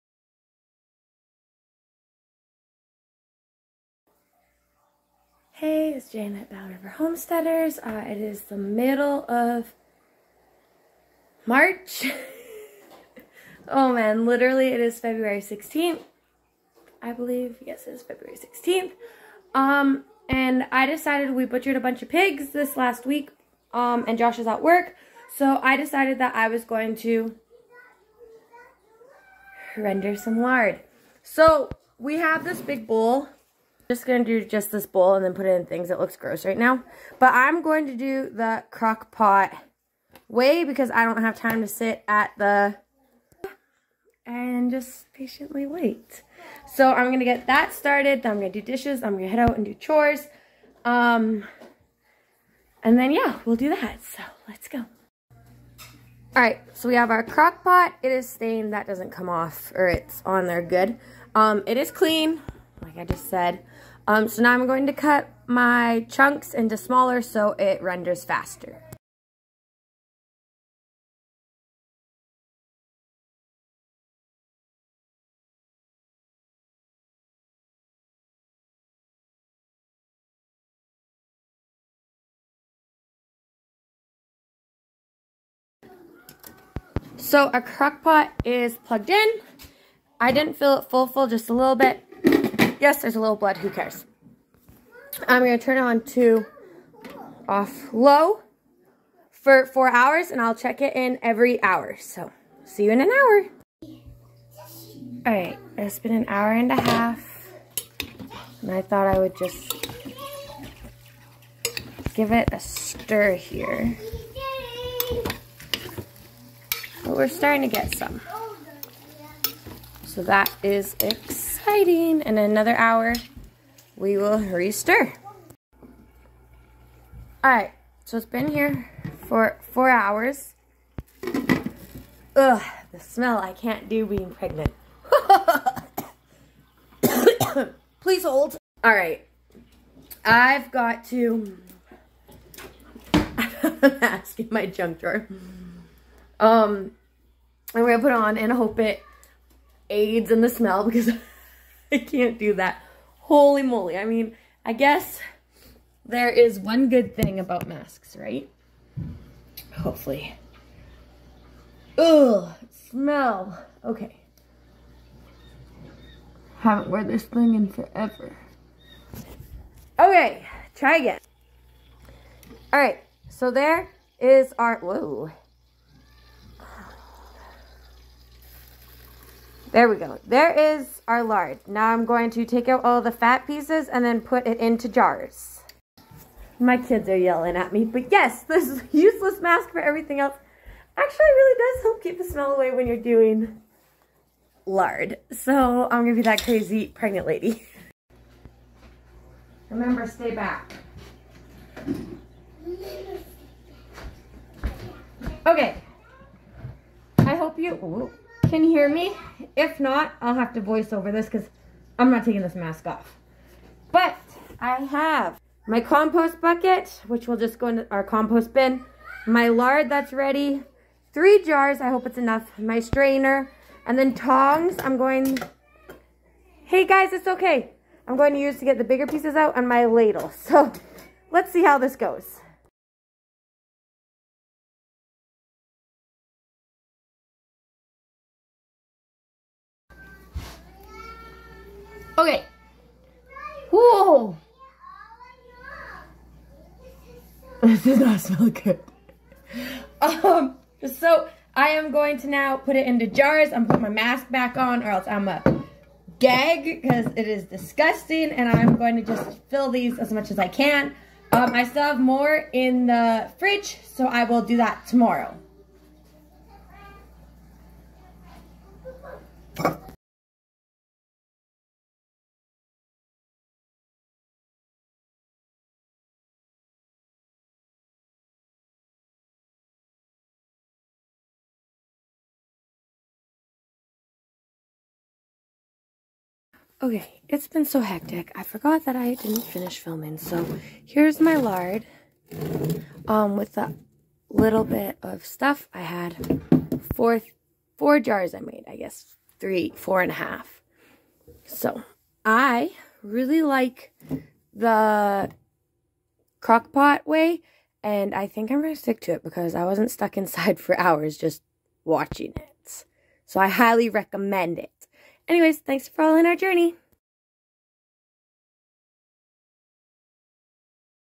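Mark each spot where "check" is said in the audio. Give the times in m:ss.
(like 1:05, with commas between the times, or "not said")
1:40.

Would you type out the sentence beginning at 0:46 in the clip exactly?
So I'm going to get that started.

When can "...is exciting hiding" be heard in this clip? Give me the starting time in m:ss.
2:00.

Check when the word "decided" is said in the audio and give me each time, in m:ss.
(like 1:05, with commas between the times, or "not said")
0:20, 0:25.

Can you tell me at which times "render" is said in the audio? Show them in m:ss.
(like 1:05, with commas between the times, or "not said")
0:29, 1:07.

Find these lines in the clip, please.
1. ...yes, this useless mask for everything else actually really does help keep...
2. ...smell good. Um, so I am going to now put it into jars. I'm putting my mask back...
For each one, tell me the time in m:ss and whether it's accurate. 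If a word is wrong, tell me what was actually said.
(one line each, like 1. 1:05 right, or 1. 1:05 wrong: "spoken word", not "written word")
1. 3:08 right
2. 4:08 right.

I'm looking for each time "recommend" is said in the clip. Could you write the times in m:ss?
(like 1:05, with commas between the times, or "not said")
5:13.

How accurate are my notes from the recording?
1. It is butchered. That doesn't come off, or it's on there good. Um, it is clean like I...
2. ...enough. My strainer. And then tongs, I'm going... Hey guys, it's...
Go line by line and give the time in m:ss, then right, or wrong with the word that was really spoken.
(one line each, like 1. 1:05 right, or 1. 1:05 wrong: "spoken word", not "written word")
1. 0:58 wrong: "stained", not "butchered"
2. 3:42 right.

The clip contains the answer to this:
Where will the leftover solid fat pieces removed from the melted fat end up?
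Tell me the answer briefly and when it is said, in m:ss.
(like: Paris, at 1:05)
compost bin, at 3:38.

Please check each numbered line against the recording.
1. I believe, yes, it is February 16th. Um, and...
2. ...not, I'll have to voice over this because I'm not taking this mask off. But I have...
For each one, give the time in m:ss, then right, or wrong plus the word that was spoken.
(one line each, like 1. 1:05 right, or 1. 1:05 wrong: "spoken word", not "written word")
1. 0:17 right
2. 3:29 right.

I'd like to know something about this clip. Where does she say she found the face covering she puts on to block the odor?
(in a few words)
junk drawer.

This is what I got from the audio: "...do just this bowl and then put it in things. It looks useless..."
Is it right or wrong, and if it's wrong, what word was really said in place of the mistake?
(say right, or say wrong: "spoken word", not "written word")
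wrong: "gross", not "useless".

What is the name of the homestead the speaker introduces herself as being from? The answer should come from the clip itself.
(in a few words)
BattleRiver Homesteaders.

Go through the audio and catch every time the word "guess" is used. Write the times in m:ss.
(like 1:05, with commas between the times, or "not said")
2:34, 4:58.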